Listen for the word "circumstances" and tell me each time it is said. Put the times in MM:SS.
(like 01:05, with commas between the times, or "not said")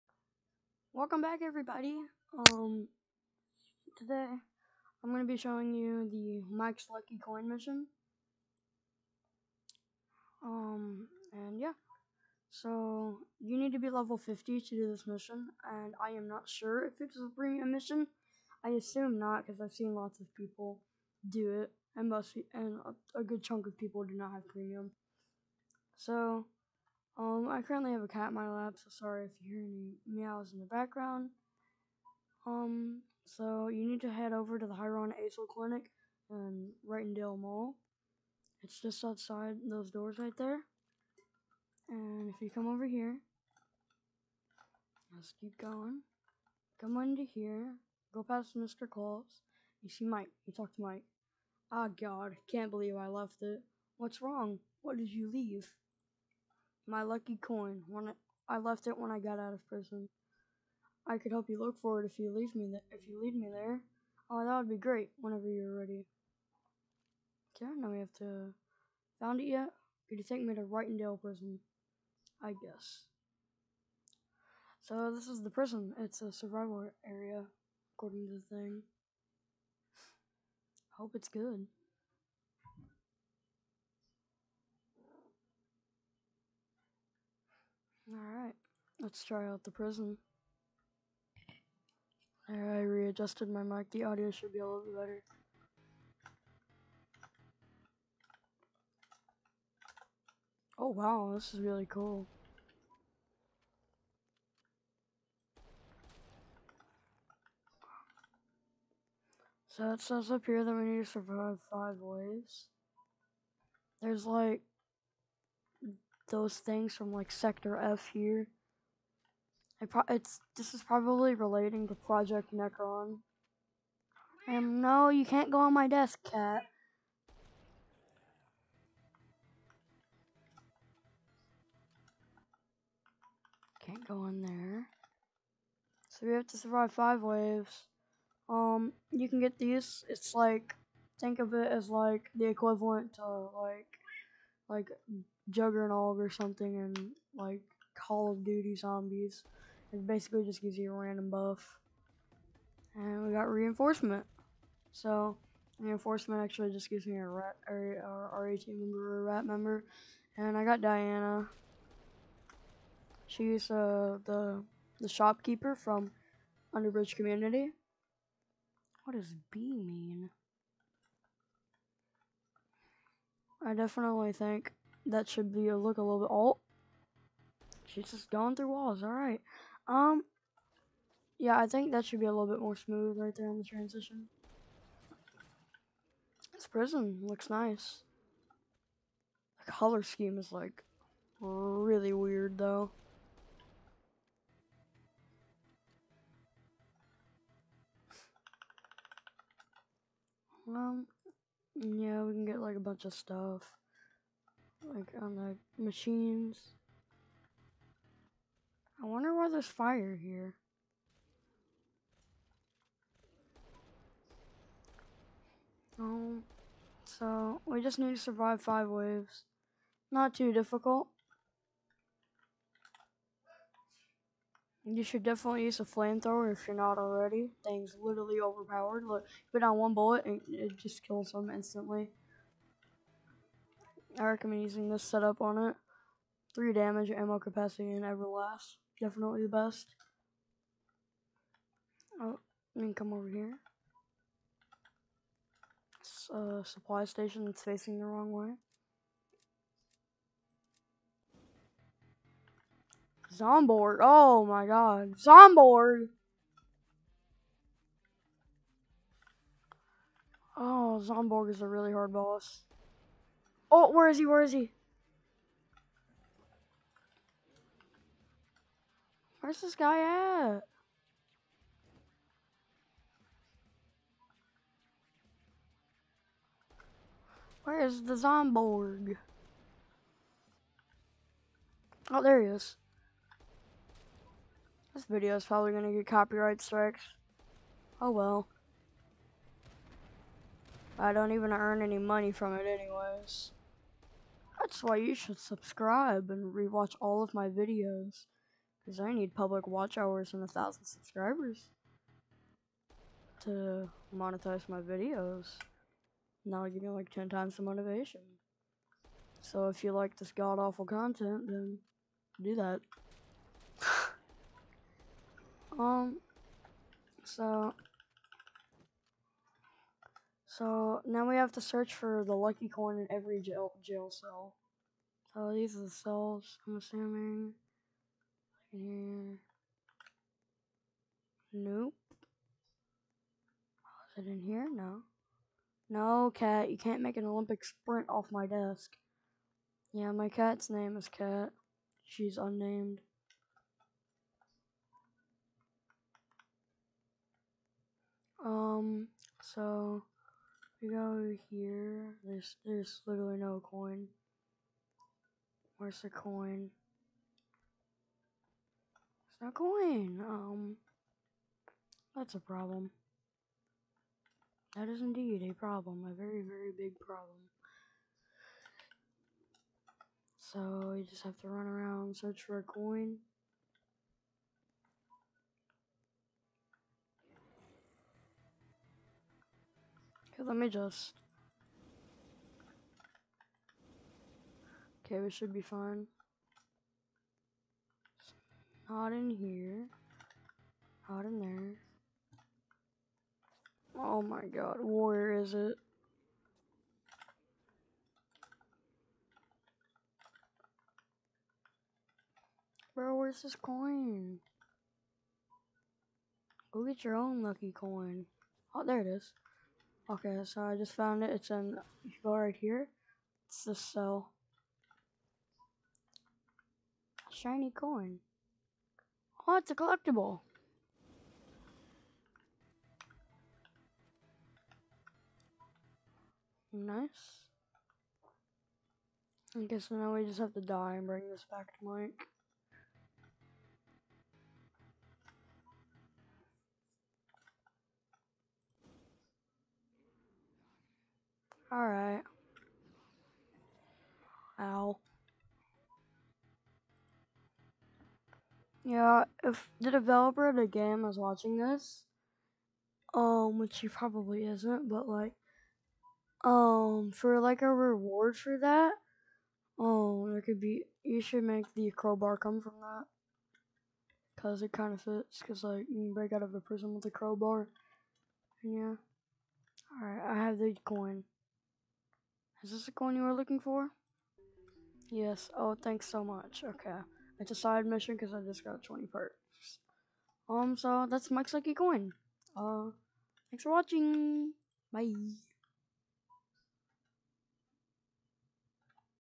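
not said.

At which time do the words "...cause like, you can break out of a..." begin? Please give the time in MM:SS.
07:45.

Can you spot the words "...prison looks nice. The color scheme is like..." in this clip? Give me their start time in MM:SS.
03:06.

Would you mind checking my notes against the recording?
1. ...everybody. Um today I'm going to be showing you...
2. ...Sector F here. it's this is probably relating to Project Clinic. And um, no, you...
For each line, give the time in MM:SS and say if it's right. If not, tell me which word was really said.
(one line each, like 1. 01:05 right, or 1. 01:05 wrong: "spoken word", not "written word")
1. 00:01 right
2. 01:57 wrong: "Necron", not "Clinic".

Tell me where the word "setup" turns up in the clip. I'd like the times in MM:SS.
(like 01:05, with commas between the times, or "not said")
03:55.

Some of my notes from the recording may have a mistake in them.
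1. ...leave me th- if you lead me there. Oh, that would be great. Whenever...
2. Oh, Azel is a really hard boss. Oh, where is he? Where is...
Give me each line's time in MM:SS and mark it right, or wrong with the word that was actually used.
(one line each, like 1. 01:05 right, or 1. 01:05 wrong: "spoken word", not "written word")
1. 01:02 right
2. 04:20 wrong: "Zomborg", not "Azel".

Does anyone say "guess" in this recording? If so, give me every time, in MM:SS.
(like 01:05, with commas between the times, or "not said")
01:12, 07:09.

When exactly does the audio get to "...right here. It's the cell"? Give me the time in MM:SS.
06:52.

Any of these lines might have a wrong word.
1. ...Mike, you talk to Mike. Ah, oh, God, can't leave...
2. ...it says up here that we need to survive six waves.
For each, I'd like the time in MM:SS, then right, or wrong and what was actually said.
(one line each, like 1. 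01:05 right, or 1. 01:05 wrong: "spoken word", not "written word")
1. 00:50 wrong: "believe", not "leave"
2. 01:49 wrong: "five", not "six".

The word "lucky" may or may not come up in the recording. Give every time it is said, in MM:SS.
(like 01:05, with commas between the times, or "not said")
00:06, 00:57, 05:22, 06:47, 08:01.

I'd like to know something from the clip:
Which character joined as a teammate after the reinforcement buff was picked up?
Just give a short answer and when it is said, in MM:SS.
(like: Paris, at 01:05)
Diana, at 02:40.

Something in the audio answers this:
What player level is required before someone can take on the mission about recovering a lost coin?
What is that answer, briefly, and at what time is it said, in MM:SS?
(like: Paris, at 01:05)
50, at 00:13.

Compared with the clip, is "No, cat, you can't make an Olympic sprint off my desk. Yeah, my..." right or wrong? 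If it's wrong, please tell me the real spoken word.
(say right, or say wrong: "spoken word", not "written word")
right.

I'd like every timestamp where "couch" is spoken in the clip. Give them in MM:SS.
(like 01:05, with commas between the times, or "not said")
not said.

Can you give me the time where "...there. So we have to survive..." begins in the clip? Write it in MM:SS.
02:14.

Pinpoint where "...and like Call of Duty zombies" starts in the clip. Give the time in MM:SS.
02:26.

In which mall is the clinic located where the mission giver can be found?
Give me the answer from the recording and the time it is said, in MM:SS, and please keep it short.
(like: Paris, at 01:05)
Wrighton Dale Mall, at 00:36.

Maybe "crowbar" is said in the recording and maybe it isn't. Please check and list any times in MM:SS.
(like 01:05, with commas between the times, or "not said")
07:41, 07:47.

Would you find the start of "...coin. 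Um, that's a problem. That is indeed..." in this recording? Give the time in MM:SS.
05:59.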